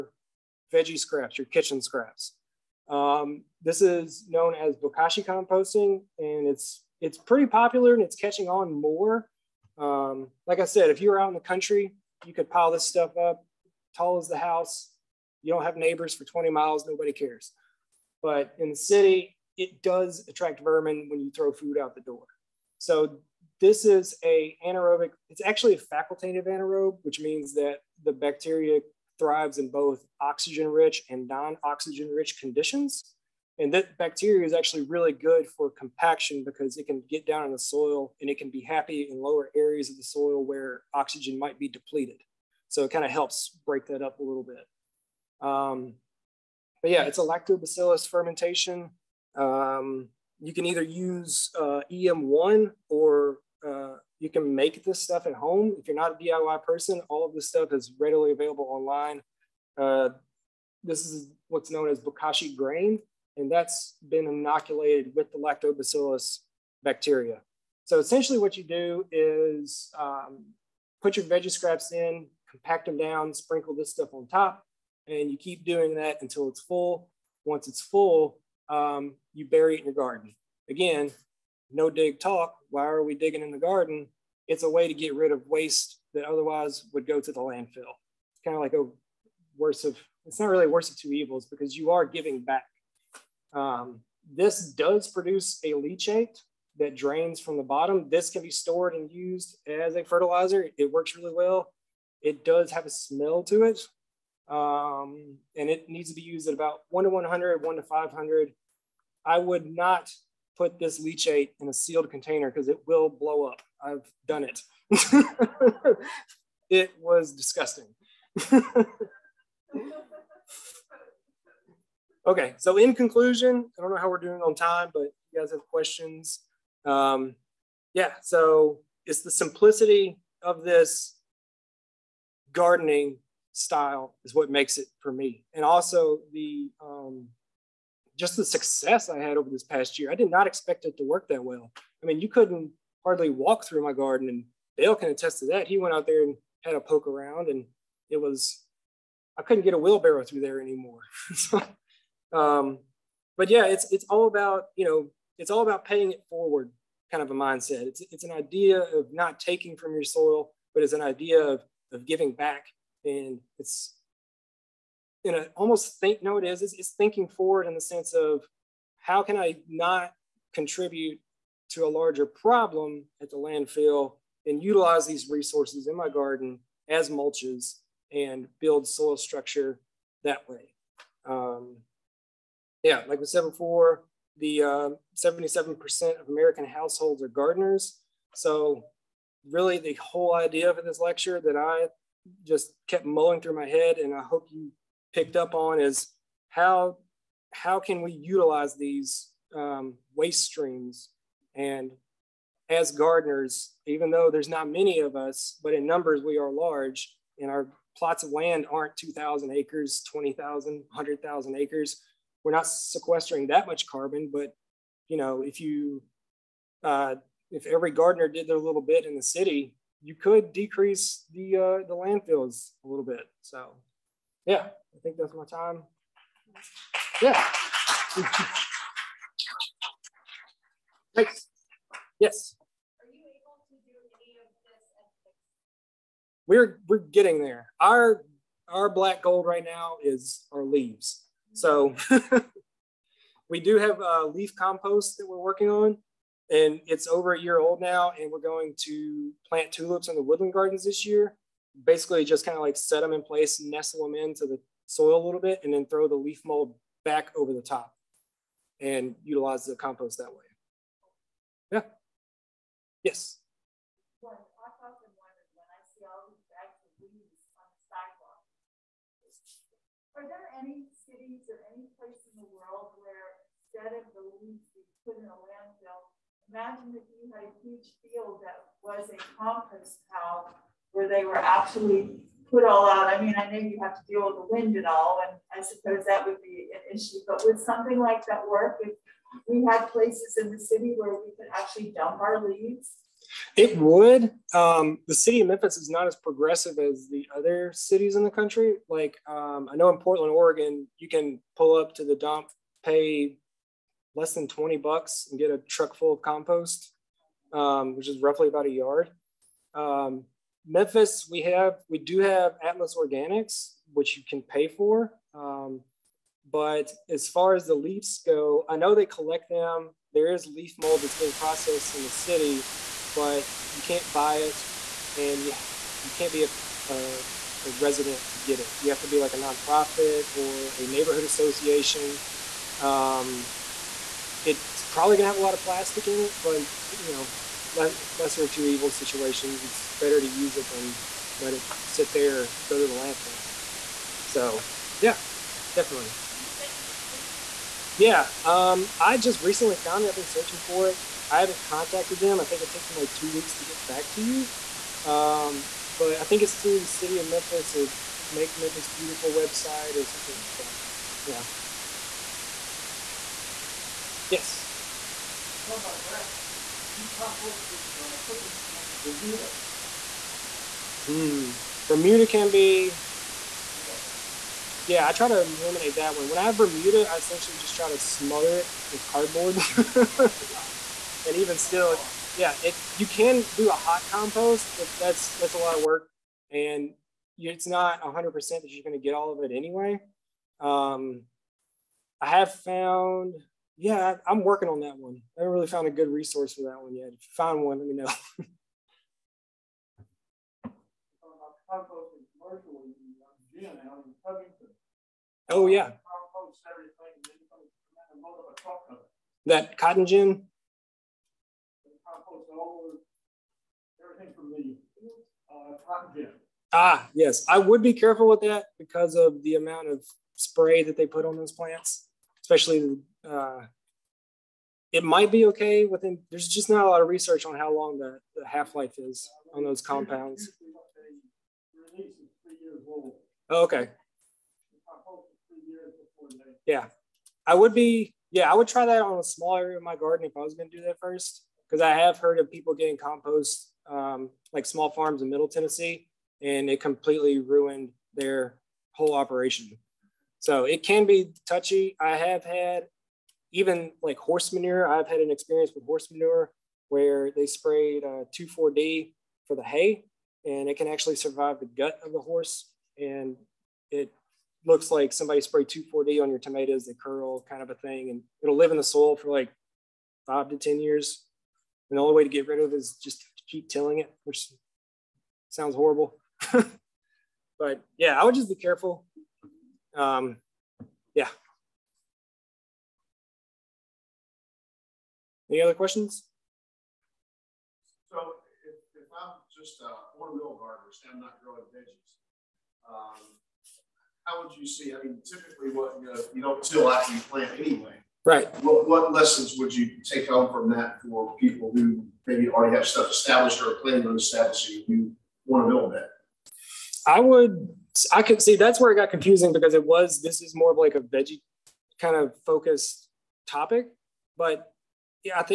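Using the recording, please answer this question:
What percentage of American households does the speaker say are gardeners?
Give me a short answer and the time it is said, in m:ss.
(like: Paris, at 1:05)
77%, at 3:05.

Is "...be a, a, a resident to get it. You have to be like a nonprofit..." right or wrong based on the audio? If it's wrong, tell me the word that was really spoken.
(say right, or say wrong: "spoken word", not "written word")
right.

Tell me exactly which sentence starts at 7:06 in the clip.
There's just not a lot of research on how long the, the half life is on those compounds.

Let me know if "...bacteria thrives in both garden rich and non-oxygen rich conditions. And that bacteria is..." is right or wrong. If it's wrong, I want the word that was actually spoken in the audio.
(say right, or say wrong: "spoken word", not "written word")
wrong: "oxygen", not "garden".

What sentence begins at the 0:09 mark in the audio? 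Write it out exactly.
Um, like I said, if you're out in the country, you could pile this stuff up tall as the house.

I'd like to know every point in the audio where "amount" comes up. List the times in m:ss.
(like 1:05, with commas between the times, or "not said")
6:59.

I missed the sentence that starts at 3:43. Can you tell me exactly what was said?
So, yeah, I think that's my time.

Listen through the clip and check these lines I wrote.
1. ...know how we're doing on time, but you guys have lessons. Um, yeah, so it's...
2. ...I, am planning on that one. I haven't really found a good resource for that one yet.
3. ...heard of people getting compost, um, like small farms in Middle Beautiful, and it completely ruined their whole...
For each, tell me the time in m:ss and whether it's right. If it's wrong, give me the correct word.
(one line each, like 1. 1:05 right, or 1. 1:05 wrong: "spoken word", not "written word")
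1. 2:03 wrong: "questions", not "lessons"
2. 6:34 wrong: "working", not "planning"
3. 7:22 wrong: "Tennessee", not "Beautiful".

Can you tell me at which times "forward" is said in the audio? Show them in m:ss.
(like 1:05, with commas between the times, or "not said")
2:36, 2:47.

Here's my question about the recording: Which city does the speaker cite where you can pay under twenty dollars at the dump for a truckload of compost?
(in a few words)
Portland, Oregon.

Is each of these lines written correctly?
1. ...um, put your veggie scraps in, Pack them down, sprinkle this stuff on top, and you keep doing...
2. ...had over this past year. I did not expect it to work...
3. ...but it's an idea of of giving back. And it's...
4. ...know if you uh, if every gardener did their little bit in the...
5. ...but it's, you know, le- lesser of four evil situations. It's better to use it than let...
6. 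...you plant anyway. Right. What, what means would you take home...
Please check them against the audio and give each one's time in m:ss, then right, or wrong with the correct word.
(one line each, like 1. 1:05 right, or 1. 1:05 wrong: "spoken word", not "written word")
1. 1:09 right
2. 2:19 right
3. 2:40 right
4. 3:35 right
5. 5:36 wrong: "two", not "four"
6. 8:17 wrong: "lessons", not "means".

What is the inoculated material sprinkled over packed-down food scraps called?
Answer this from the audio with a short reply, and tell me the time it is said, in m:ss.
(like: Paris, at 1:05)
bokashi grain, at 1:01.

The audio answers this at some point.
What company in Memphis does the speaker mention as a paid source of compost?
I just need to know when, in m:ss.
5:12.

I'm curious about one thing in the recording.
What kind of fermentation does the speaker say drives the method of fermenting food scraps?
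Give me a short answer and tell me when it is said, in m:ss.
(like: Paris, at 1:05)
lactobacillus fermentation, at 0:47.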